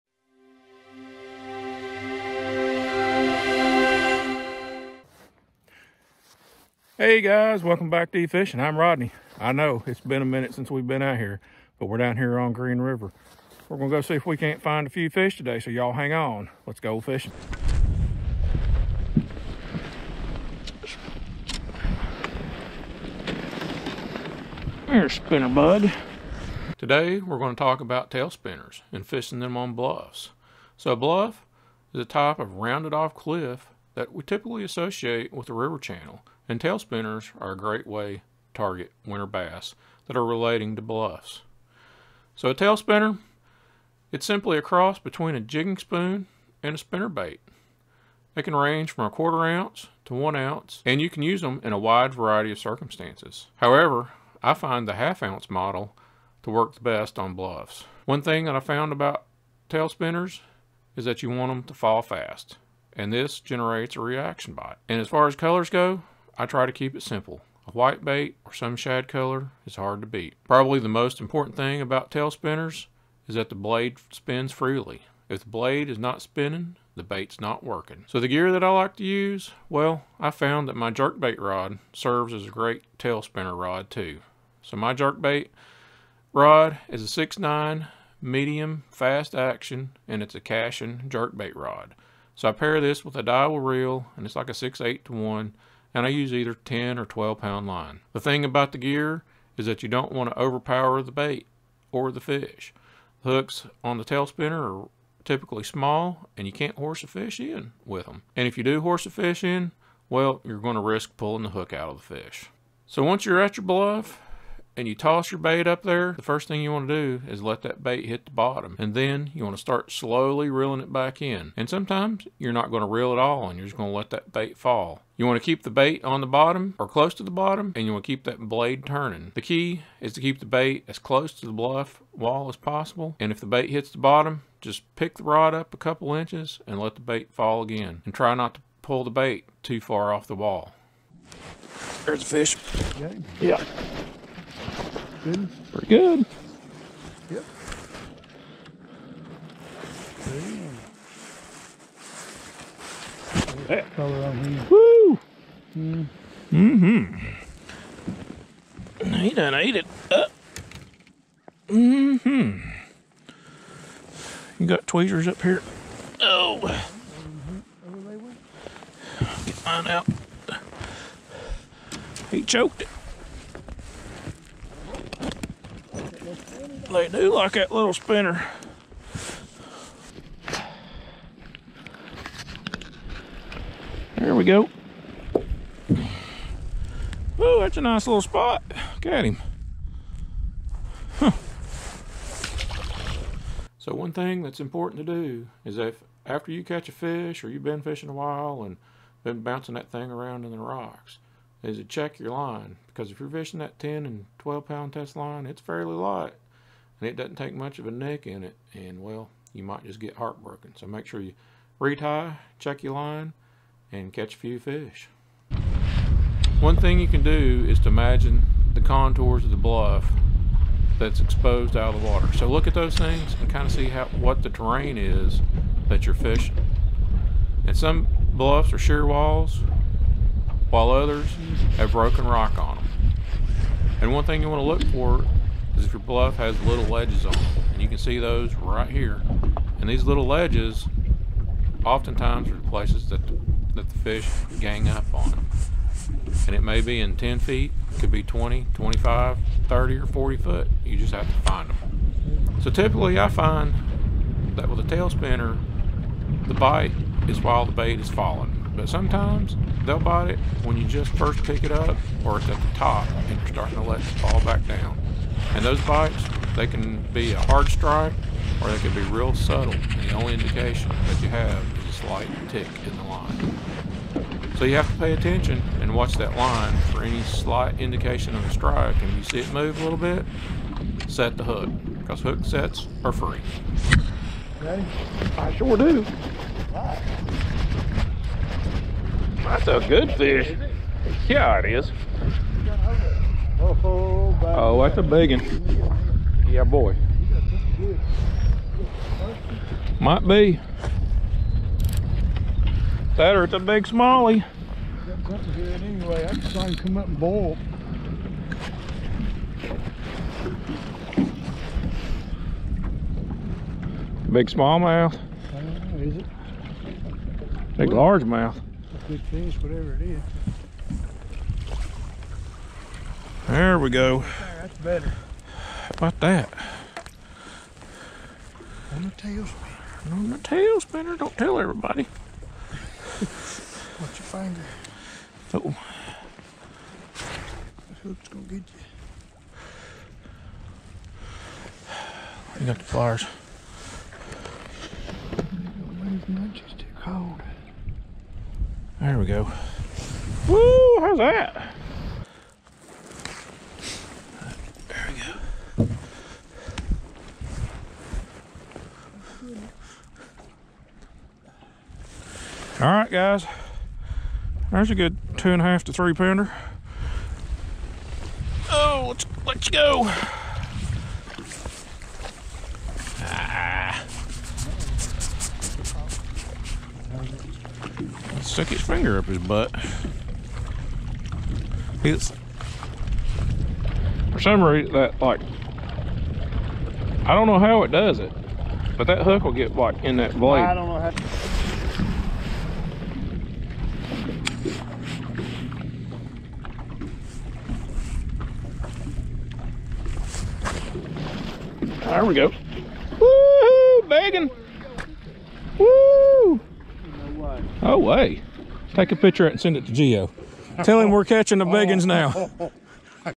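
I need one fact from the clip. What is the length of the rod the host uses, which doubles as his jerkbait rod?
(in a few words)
6'9".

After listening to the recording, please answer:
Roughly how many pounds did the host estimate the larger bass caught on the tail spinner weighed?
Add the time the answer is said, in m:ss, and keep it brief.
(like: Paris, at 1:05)
2.5 to 3, at 6:05.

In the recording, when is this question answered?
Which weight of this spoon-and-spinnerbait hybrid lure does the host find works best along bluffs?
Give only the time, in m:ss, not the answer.
0:54.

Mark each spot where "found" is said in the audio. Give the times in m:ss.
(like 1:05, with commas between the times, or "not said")
0:58, 1:20.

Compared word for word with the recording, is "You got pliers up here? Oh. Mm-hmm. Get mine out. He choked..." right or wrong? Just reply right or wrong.
wrong.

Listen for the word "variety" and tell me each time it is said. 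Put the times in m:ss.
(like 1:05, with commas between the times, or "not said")
0:52.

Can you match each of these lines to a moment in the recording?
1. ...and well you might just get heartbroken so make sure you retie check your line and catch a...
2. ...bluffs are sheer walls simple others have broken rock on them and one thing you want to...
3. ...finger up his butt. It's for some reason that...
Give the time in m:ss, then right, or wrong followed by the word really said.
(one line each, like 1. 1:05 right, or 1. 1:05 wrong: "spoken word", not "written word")
1. 3:28 right
2. 3:48 wrong: "while", not "simple"
3. 6:18 right.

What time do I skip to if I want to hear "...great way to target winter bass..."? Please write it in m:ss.
0:37.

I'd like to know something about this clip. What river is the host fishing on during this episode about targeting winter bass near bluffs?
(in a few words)
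Green River.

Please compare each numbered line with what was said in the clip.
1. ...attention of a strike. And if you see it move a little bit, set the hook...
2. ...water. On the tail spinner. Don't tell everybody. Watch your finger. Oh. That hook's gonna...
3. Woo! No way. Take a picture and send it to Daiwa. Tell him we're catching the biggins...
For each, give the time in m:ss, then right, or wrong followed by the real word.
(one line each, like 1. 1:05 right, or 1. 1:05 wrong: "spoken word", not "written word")
1. 4:37 wrong: "indication", not "attention"
2. 5:29 wrong: "tailspinner", not "water"
3. 6:45 wrong: "Geo", not "Daiwa".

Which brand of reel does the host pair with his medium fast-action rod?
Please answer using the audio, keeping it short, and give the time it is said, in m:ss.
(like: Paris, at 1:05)
Daiwa, at 1:33.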